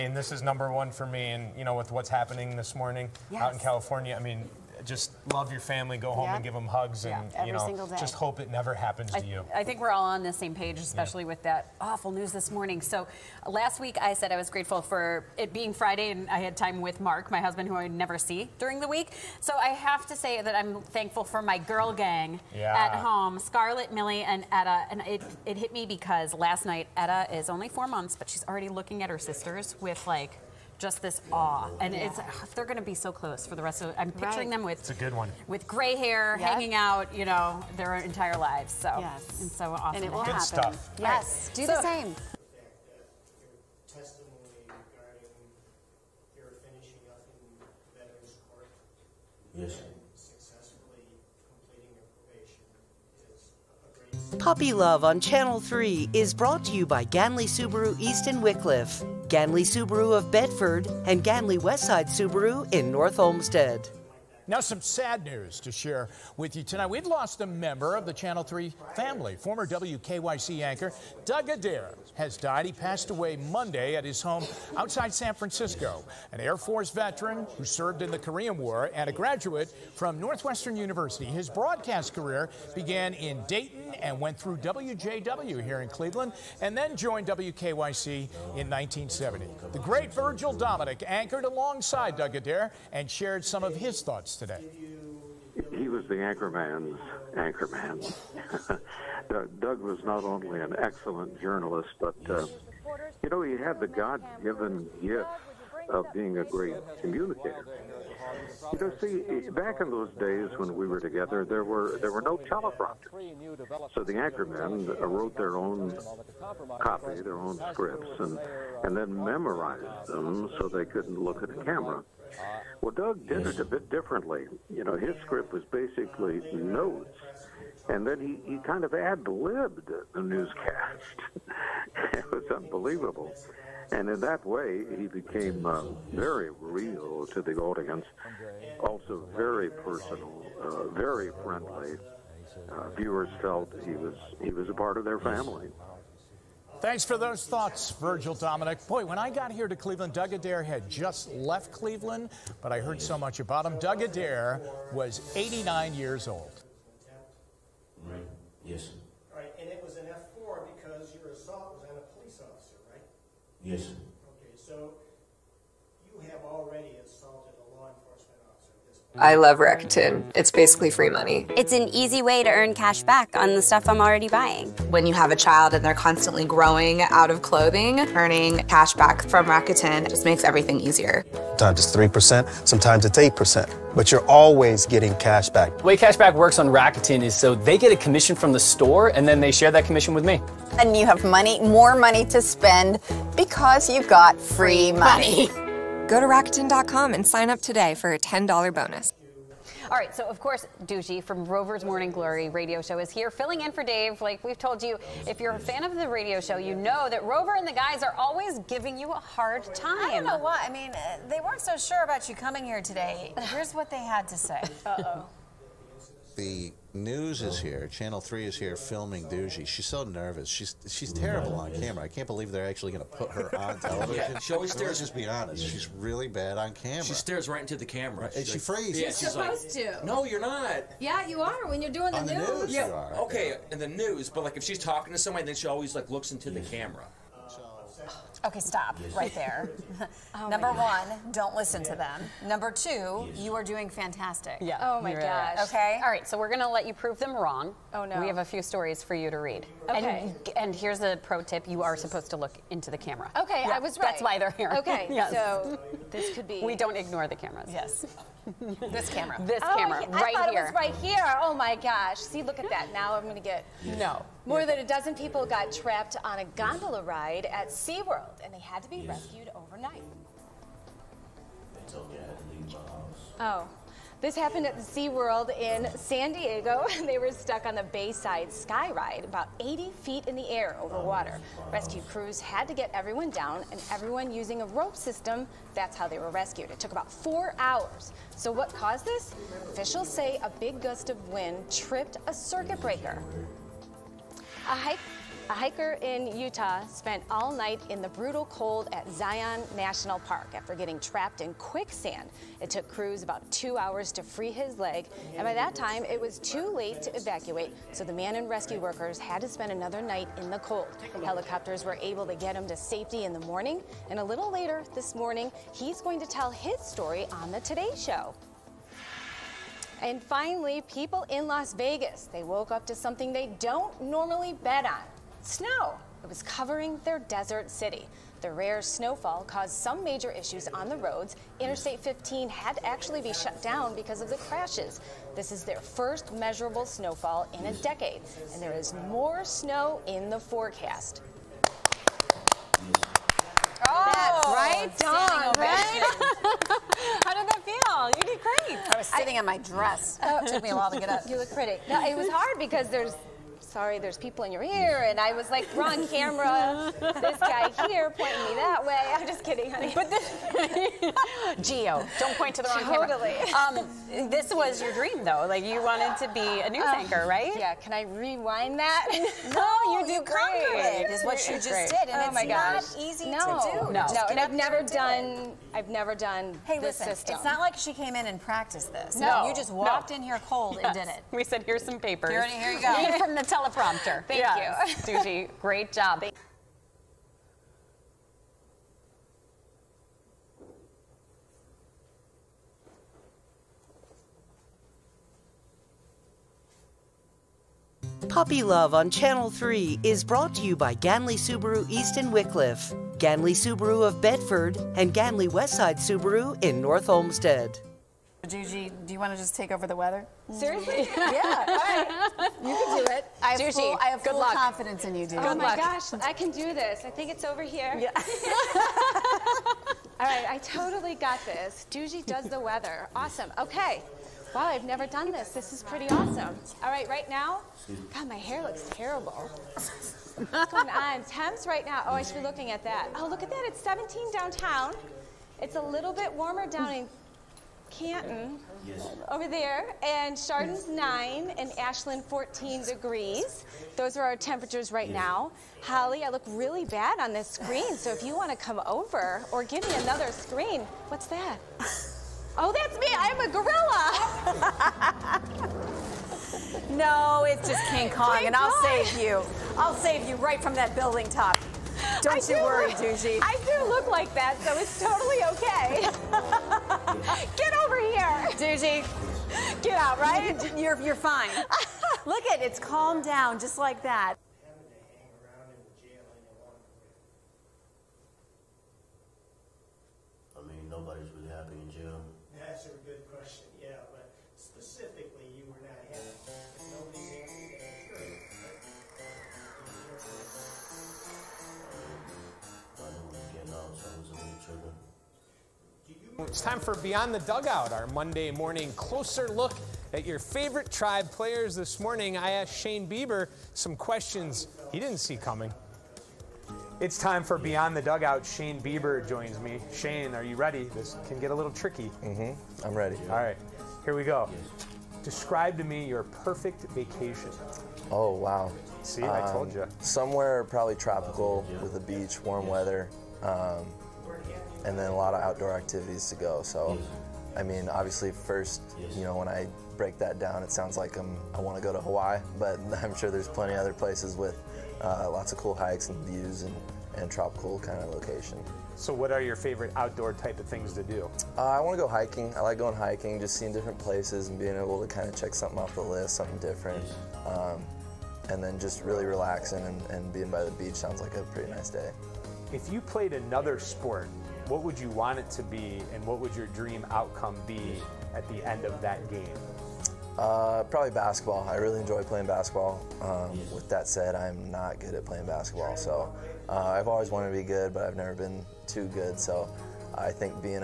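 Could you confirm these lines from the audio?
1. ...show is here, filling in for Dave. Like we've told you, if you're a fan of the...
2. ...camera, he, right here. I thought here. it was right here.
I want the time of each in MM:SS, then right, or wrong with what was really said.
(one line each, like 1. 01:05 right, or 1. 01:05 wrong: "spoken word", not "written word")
1. 03:22 right
2. 04:19 right.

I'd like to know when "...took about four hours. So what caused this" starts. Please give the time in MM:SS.
04:46.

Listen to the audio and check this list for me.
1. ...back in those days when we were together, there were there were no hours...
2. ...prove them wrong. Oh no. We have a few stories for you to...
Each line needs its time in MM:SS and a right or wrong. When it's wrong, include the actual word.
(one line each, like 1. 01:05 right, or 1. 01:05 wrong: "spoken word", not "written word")
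1. 01:49 wrong: "teleprompters", not "hours"
2. 04:06 right.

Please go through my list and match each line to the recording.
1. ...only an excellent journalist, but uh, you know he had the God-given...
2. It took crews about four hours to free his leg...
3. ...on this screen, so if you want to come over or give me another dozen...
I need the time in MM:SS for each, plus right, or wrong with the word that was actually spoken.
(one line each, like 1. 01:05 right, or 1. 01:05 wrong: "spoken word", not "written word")
1. 01:40 right
2. 05:02 wrong: "two", not "four"
3. 07:27 wrong: "screen", not "dozen".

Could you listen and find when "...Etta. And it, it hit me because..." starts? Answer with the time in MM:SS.
00:24.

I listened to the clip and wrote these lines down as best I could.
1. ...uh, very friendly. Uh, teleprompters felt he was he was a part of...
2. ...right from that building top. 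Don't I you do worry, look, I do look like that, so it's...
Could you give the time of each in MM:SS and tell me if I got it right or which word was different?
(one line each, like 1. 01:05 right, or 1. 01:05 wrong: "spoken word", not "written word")
1. 02:20 wrong: "viewers", not "teleprompters"
2. 07:40 right.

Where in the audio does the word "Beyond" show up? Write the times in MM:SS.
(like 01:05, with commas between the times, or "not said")
08:16, 08:27.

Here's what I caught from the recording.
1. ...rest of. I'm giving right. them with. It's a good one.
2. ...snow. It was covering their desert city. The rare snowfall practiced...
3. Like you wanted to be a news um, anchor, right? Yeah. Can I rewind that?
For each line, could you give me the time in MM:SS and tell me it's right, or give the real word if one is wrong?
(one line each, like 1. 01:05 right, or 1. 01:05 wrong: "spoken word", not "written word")
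1. 00:33 wrong: "picturing", not "giving"
2. 05:25 wrong: "caused", not "practiced"
3. 06:05 right.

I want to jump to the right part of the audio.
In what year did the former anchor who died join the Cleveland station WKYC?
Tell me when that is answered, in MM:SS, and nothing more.
01:28.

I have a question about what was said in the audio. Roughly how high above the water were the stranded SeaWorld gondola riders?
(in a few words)
80 feet.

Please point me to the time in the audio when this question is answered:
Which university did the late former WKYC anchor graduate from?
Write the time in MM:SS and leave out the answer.
01:20.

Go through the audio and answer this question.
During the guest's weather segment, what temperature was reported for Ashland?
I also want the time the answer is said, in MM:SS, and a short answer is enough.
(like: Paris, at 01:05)
14 degrees, at 07:21.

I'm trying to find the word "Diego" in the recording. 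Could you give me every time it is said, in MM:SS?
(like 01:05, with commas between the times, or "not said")
04:36.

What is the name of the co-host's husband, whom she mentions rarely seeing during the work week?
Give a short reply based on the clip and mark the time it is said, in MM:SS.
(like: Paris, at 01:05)
Mark, at 00:17.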